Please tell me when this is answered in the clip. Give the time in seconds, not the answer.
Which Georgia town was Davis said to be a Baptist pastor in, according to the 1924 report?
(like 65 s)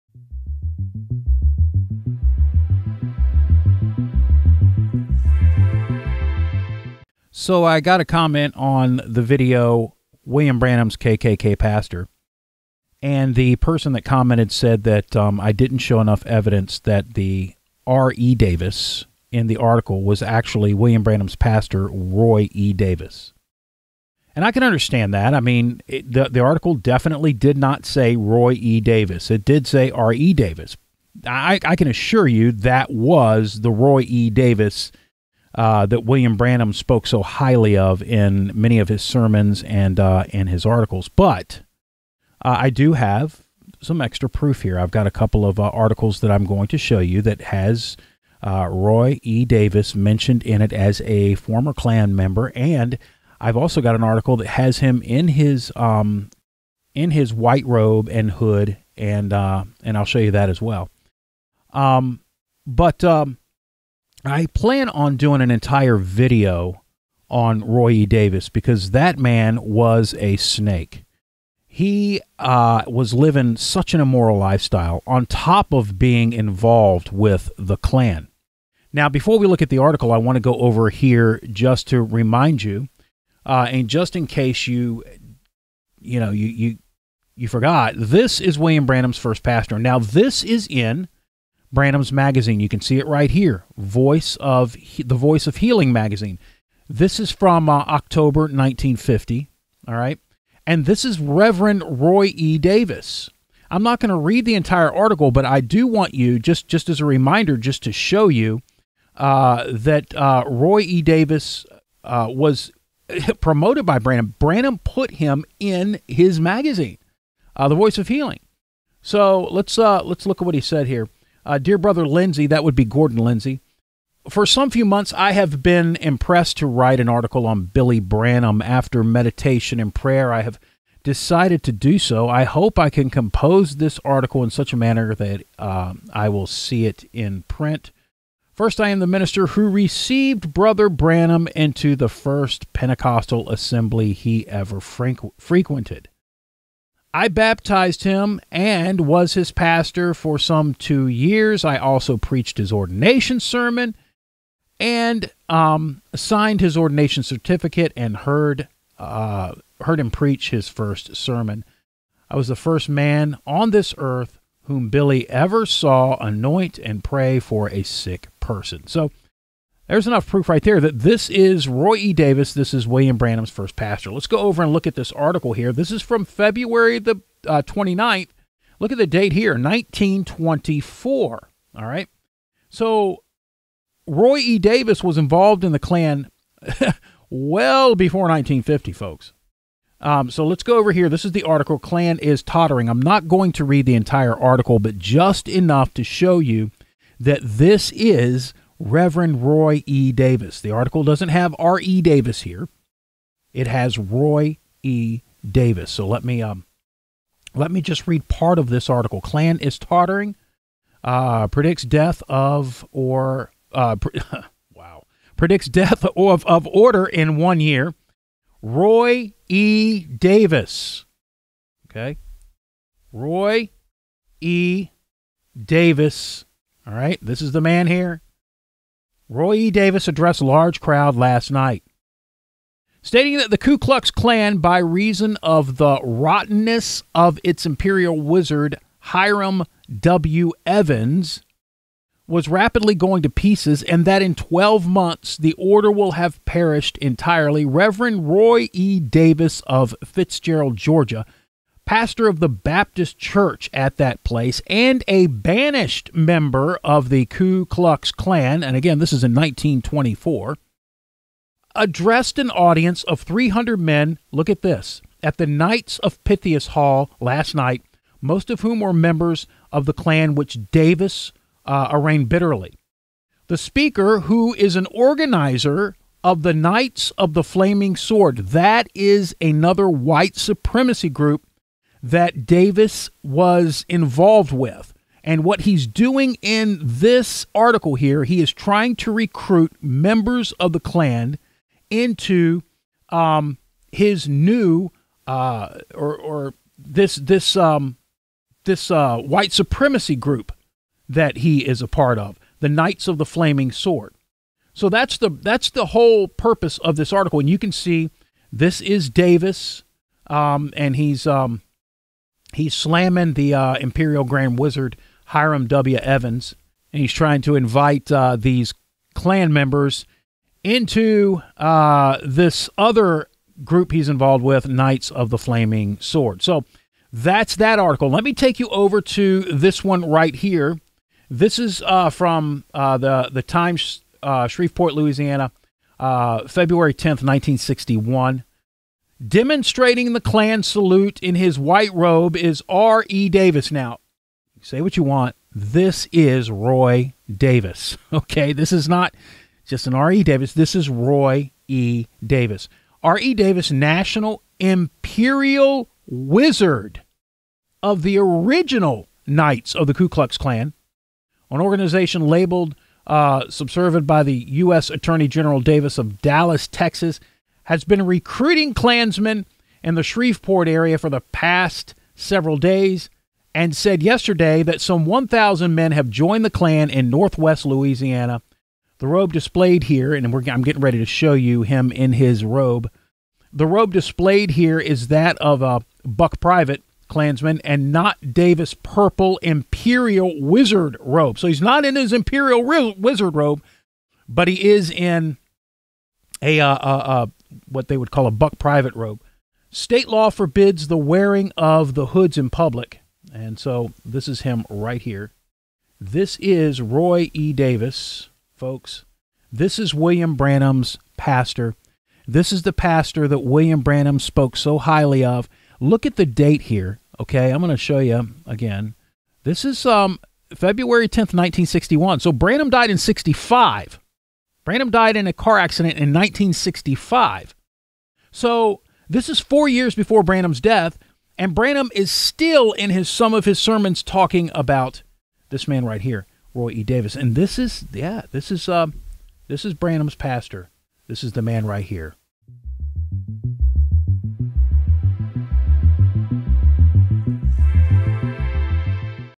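250 s.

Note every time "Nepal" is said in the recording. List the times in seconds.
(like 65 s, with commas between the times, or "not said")
not said.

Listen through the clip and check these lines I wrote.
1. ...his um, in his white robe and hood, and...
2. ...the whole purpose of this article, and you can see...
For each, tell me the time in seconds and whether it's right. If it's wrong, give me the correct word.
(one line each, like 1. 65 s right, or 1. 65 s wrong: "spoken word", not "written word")
1. 55 s right
2. 305 s right.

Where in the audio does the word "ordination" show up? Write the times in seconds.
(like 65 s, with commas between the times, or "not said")
152 s, 156 s.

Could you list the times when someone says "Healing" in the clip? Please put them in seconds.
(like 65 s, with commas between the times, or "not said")
95 s, 118 s.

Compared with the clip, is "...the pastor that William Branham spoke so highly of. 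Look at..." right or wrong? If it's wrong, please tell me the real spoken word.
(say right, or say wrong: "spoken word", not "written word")
right.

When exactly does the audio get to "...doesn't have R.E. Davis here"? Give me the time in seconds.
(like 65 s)
201 s.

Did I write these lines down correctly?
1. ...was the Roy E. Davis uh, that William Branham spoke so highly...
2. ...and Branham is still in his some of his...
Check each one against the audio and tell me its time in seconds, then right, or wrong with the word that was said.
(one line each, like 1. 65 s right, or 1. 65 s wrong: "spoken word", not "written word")
1. 32 s right
2. 431 s right.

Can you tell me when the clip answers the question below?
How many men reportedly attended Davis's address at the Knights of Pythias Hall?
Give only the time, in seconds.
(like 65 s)
263 s.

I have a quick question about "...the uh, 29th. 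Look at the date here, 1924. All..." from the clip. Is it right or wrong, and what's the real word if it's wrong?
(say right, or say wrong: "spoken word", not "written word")
right.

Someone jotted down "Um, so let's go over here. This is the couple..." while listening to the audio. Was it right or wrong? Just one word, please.
wrong.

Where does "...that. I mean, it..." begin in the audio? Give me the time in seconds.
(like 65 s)
25 s.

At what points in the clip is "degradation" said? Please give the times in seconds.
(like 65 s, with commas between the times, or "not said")
not said.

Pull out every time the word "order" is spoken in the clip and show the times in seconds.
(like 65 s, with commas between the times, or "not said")
216 s, 245 s.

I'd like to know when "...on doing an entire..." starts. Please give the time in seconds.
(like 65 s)
64 s.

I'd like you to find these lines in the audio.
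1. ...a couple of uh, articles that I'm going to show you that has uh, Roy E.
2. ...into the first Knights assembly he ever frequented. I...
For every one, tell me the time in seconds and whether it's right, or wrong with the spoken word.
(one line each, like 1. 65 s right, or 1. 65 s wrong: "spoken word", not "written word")
1. 45 s right
2. 141 s wrong: "Pentecostal", not "Knights".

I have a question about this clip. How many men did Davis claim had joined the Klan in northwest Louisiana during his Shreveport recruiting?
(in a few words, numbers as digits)
1,000.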